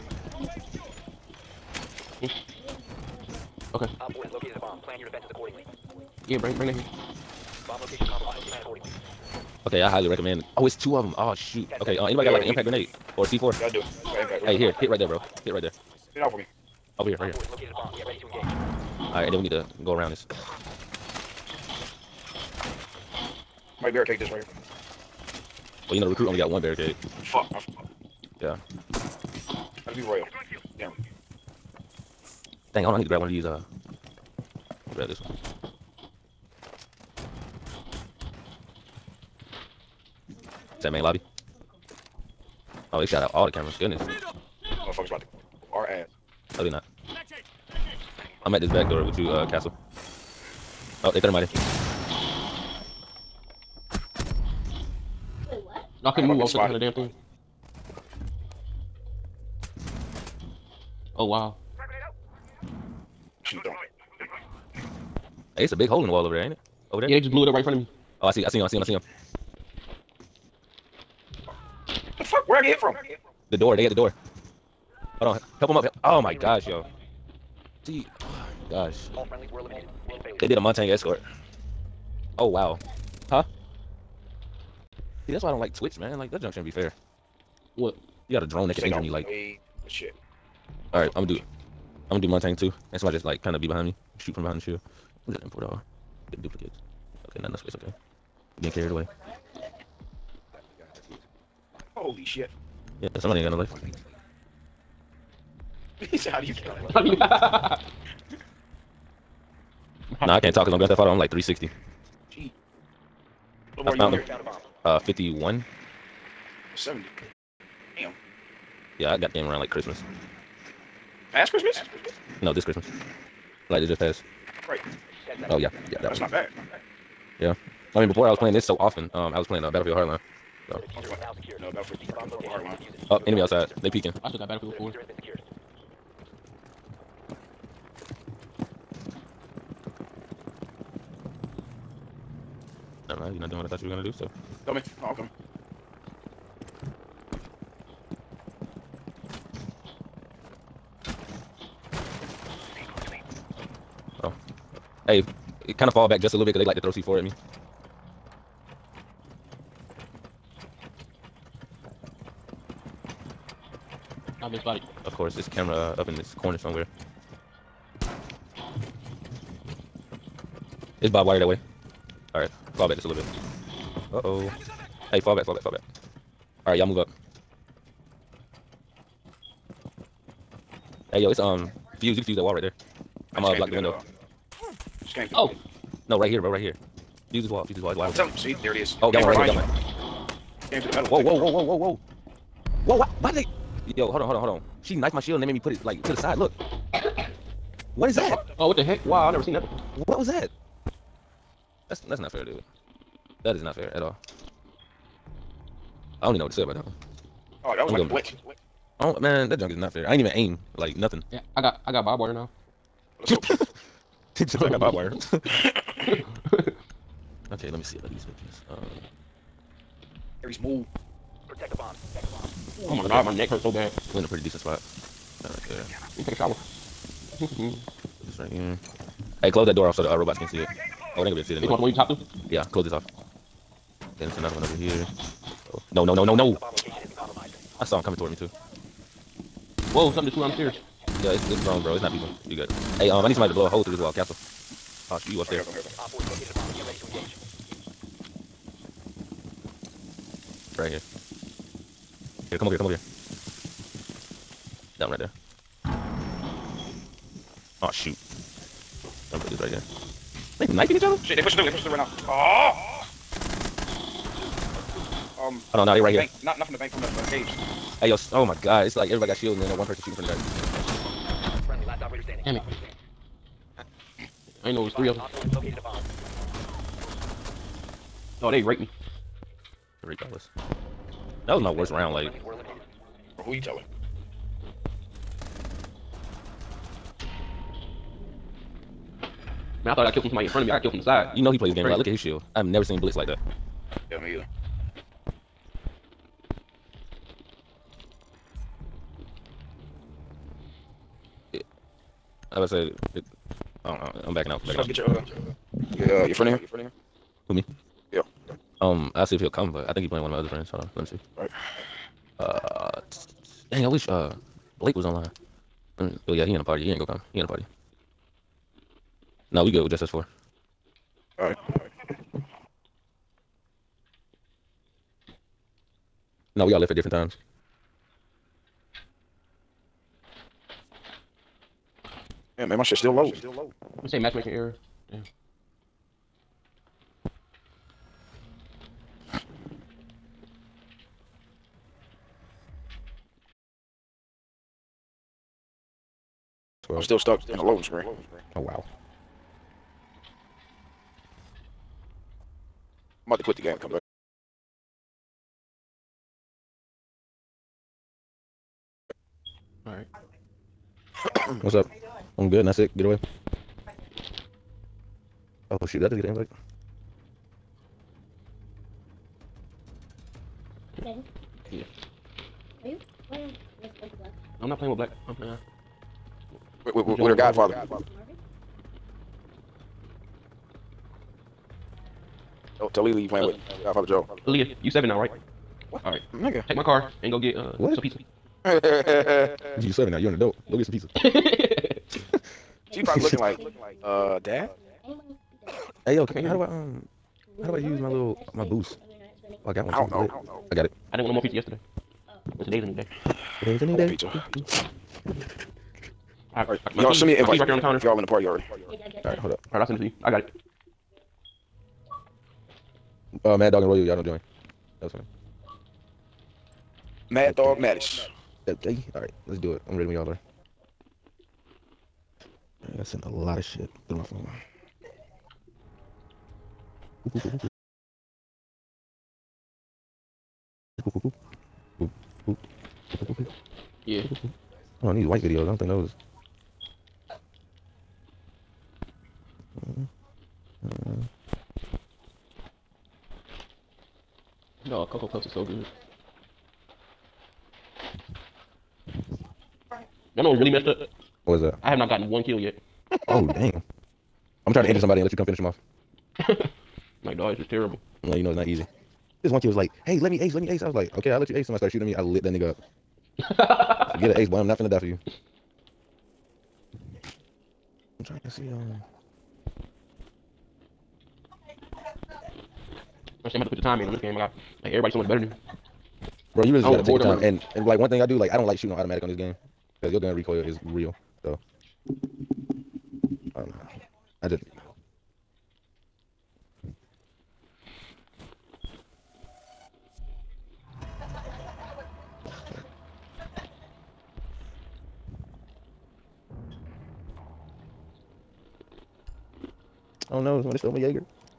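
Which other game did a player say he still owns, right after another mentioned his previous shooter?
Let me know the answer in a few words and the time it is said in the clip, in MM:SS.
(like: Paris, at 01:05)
Battlefield 4, at 02:14.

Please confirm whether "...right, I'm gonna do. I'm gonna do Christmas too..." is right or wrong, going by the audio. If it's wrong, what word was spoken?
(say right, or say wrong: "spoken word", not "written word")
wrong: "Montagne", not "Christmas".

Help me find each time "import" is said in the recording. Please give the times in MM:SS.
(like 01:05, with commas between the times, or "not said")
01:35.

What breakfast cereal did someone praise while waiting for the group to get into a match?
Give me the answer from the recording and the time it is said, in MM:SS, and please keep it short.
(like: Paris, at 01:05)
Cocoa Puffs, at 07:25.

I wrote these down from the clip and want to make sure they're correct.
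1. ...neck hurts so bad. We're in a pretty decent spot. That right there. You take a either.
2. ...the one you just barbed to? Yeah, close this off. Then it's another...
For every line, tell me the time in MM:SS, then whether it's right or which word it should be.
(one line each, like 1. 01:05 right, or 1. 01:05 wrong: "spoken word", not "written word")
1. 03:43 wrong: "shower", not "either"
2. 03:51 wrong: "hopped", not "barbed".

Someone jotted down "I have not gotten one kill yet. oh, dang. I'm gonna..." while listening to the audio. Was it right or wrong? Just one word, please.
right.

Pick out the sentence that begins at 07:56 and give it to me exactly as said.
Bro, you really just gotta take your time.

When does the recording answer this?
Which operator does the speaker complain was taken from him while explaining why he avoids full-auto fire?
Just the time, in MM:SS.
08:20.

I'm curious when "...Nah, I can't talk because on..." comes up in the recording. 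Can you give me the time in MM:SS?
01:50.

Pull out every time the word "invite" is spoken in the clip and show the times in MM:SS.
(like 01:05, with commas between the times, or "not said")
06:06, 06:47.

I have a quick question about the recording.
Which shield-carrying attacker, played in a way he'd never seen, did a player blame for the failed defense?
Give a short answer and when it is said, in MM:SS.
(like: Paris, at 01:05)
Blitz, at 04:53.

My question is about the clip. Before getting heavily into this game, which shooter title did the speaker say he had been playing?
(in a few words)
Battlefield Hardline.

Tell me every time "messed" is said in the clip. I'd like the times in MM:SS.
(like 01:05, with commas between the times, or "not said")
07:30.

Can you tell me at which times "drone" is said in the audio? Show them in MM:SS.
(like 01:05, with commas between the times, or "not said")
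01:28, 04:01.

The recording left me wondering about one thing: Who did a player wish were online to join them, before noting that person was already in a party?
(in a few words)
Blake.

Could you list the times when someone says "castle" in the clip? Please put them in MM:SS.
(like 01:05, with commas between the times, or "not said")
00:49, 04:04.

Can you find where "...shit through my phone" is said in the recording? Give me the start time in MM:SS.
07:03.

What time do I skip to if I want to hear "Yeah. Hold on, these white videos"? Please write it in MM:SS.
07:14.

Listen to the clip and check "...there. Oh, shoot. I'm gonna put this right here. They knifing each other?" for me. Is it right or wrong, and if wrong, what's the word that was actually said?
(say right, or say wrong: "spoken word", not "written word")
right.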